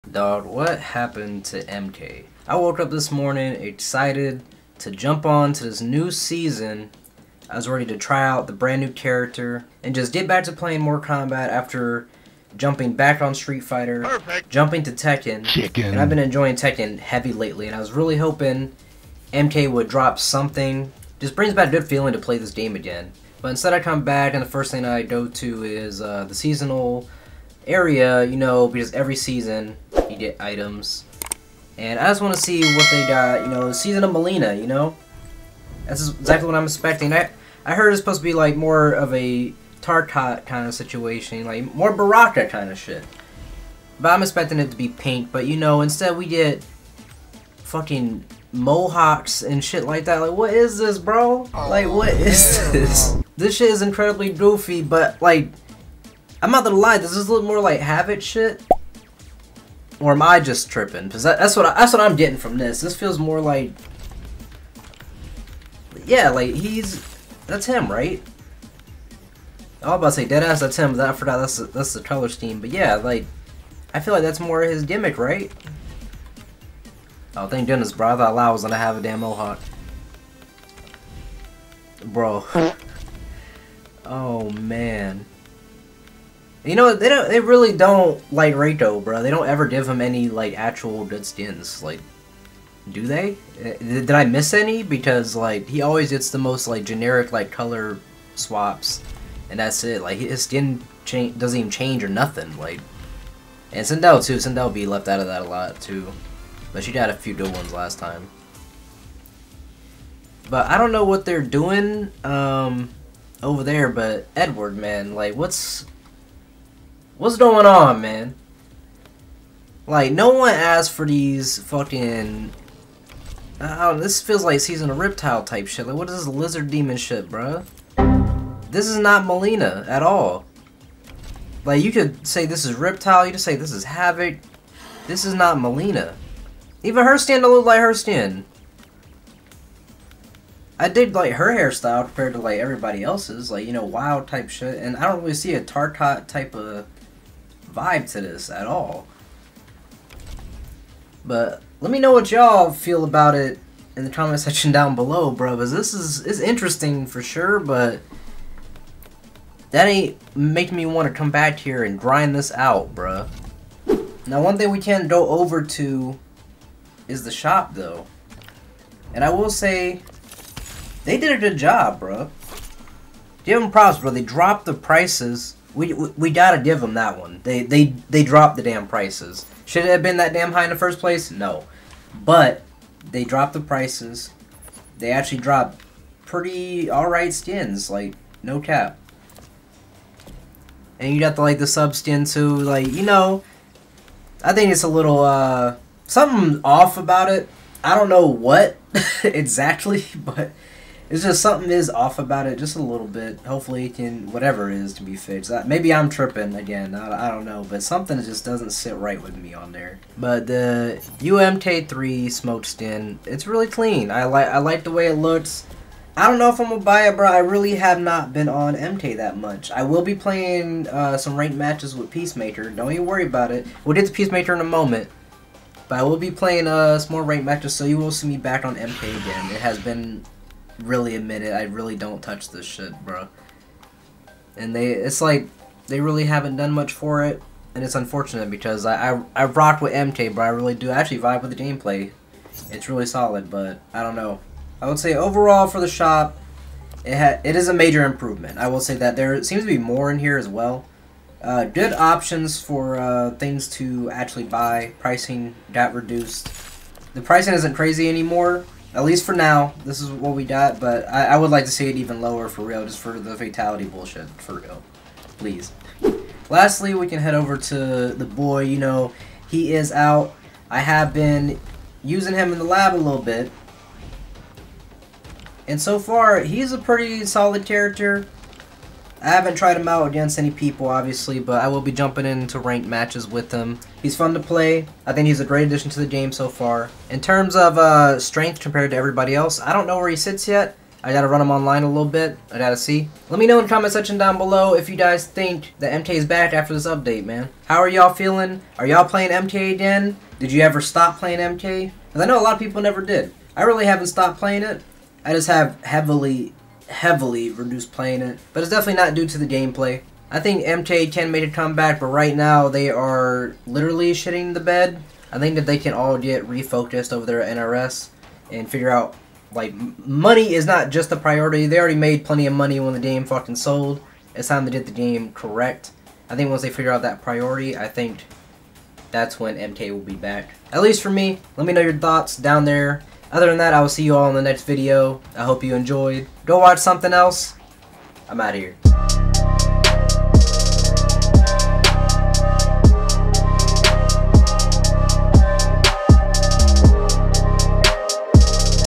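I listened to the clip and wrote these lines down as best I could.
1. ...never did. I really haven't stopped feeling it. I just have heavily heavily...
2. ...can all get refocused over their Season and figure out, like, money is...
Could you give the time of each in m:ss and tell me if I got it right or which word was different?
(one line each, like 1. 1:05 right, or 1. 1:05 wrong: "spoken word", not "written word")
1. 5:02 wrong: "playing", not "feeling"
2. 5:15 wrong: "NRS", not "Season".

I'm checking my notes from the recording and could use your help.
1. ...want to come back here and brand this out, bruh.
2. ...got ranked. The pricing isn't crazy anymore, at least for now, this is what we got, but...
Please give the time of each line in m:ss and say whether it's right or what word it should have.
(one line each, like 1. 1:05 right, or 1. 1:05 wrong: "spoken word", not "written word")
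1. 2:40 wrong: "grind", not "brand"
2. 4:15 wrong: "reduced", not "ranked".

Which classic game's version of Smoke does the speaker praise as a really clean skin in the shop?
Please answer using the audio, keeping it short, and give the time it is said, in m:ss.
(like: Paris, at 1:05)
UMK3, at 3:31.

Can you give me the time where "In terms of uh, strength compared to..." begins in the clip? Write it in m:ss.
4:47.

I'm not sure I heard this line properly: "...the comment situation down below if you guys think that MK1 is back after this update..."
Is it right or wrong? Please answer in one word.
wrong.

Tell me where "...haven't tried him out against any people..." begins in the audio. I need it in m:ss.
4:39.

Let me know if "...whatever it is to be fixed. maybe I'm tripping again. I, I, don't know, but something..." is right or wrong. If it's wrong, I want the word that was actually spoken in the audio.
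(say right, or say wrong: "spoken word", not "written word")
right.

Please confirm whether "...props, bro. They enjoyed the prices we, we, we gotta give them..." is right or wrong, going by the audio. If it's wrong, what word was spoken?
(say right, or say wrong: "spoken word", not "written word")
wrong: "dropped", not "enjoyed".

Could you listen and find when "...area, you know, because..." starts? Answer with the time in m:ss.
0:27.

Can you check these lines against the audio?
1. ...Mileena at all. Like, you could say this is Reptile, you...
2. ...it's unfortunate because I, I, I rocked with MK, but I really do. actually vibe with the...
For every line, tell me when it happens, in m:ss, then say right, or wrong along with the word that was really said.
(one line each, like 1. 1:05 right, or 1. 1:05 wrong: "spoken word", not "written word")
1. 2:09 right
2. 3:57 right.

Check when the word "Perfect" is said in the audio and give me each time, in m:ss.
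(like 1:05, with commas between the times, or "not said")
0:14.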